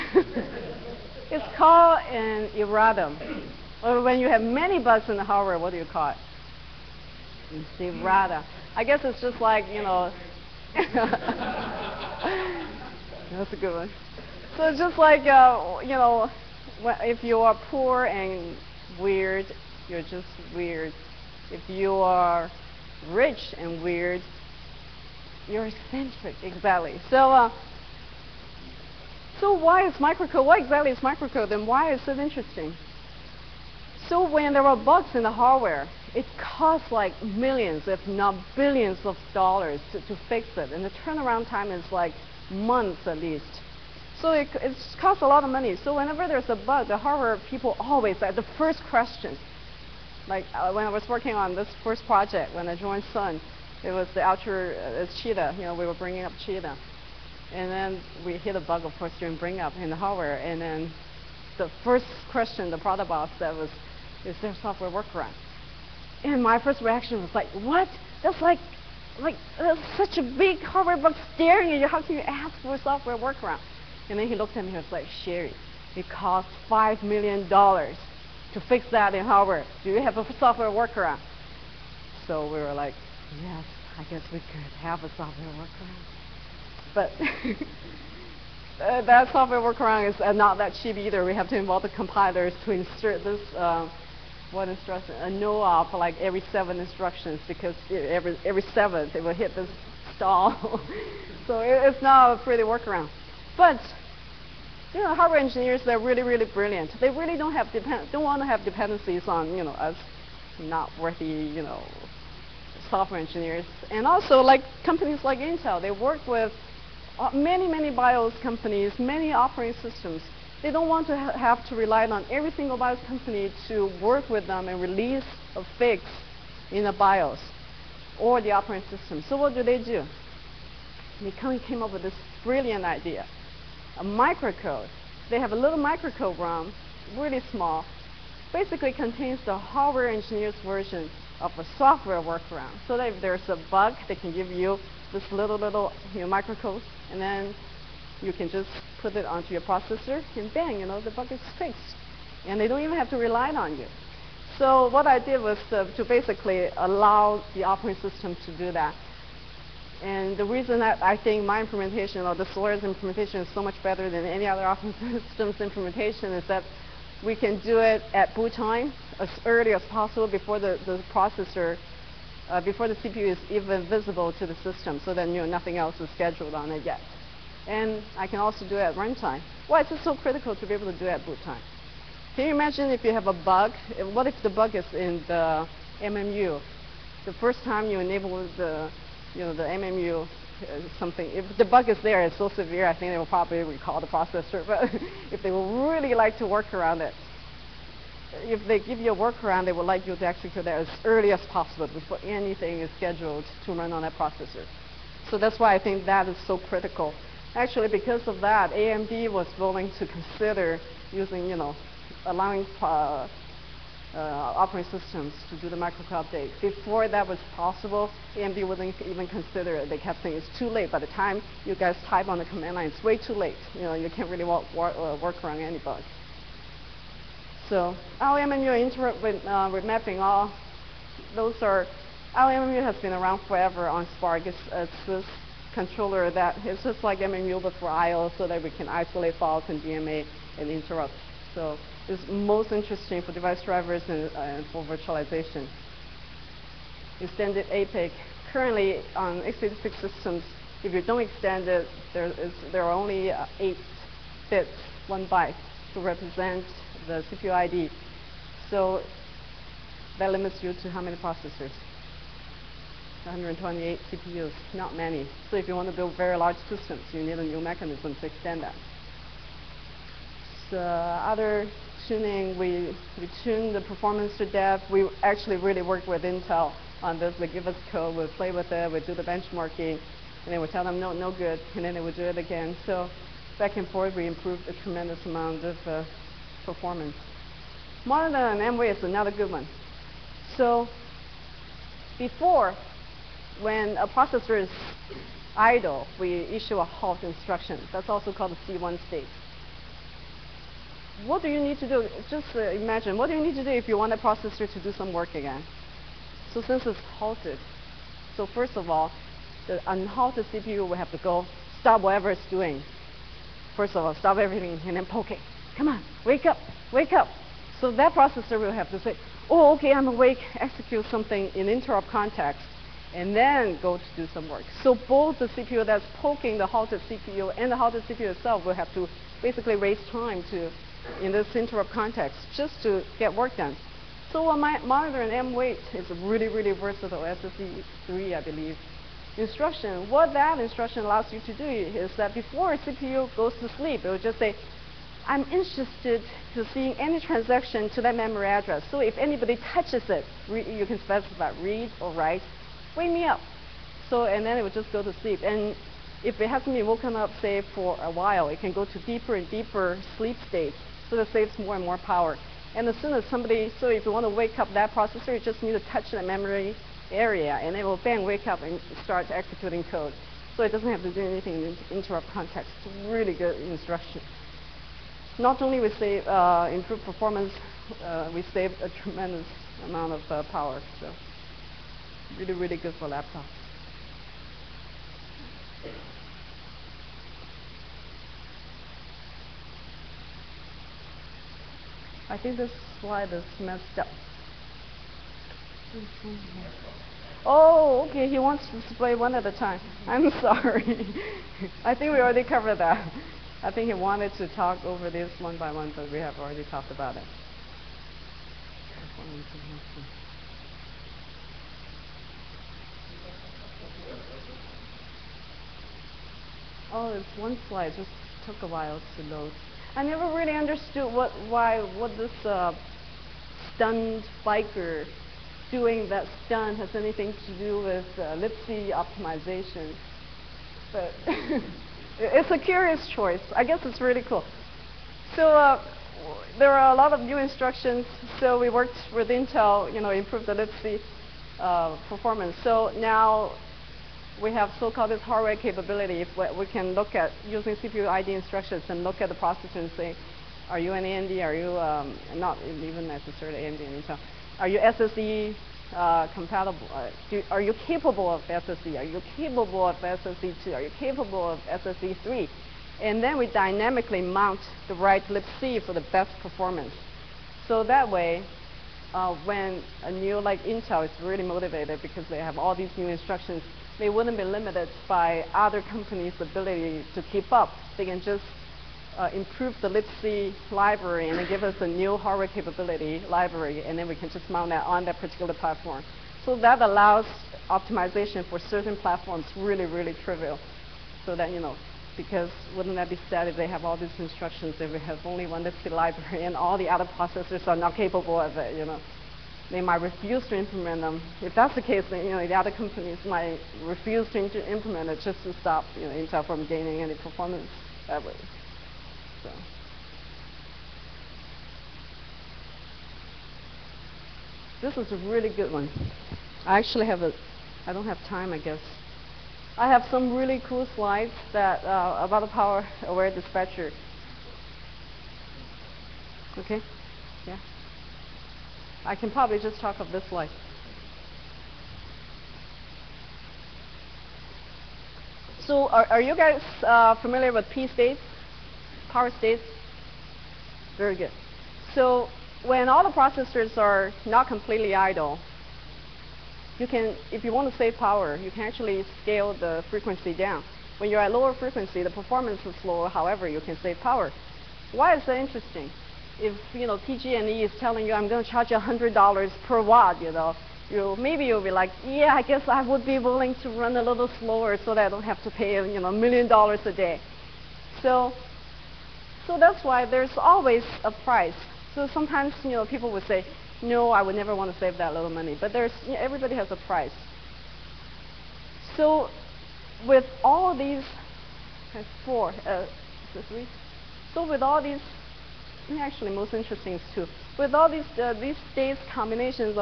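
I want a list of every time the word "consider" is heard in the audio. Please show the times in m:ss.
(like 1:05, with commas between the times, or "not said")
3:30, 3:39.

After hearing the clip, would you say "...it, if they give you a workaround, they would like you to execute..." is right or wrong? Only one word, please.
right.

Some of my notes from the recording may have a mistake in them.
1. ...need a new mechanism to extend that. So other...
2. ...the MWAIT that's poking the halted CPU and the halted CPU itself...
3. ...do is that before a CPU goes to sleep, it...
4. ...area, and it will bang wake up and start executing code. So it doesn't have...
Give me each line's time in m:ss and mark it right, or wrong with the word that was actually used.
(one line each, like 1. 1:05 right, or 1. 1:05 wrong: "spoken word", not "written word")
1. 4:27 right
2. 5:25 wrong: "CPU", not "MWAIT"
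3. 5:41 right
4. 6:07 right.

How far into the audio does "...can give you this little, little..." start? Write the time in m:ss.
2:24.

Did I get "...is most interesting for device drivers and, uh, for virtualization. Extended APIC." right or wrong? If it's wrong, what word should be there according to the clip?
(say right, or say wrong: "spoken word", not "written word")
right.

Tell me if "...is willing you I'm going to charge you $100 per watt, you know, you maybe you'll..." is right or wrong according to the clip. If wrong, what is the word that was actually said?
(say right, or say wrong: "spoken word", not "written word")
wrong: "telling", not "willing".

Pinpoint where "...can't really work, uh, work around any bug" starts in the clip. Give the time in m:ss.
3:44.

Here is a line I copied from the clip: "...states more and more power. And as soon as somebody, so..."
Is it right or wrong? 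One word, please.
wrong.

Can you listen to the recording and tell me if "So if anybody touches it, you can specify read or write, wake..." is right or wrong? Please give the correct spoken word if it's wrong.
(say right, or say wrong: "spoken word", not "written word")
right.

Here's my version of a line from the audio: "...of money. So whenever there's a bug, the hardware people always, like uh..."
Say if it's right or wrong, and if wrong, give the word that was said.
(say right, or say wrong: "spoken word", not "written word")
right.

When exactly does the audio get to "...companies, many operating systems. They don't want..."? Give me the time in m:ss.
1:58.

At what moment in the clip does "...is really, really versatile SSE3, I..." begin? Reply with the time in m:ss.
5:35.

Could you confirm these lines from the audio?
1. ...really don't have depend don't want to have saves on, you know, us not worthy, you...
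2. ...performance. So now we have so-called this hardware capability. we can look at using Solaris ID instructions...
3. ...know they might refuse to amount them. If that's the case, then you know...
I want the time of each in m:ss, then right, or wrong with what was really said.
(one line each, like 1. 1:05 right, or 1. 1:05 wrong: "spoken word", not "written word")
1. 1:47 wrong: "dependencies", not "saves"
2. 7:22 wrong: "CPU", not "Solaris"
3. 8:18 wrong: "implement", not "amount".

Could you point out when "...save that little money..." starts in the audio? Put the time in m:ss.
9:34.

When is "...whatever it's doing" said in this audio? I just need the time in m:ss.
5:12.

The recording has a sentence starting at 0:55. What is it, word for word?
You know, we were bringing up cheetah, and then we hit a bug, of course, during bring up in the hardware.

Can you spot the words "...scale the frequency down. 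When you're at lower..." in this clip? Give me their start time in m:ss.
9:09.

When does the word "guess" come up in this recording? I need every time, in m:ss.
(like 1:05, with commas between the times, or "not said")
0:08, 1:24, 7:13, 8:38, 9:22.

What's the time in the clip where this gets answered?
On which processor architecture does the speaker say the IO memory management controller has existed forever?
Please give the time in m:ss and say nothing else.
3:54.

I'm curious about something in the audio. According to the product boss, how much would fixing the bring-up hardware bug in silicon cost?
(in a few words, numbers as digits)
$5 million.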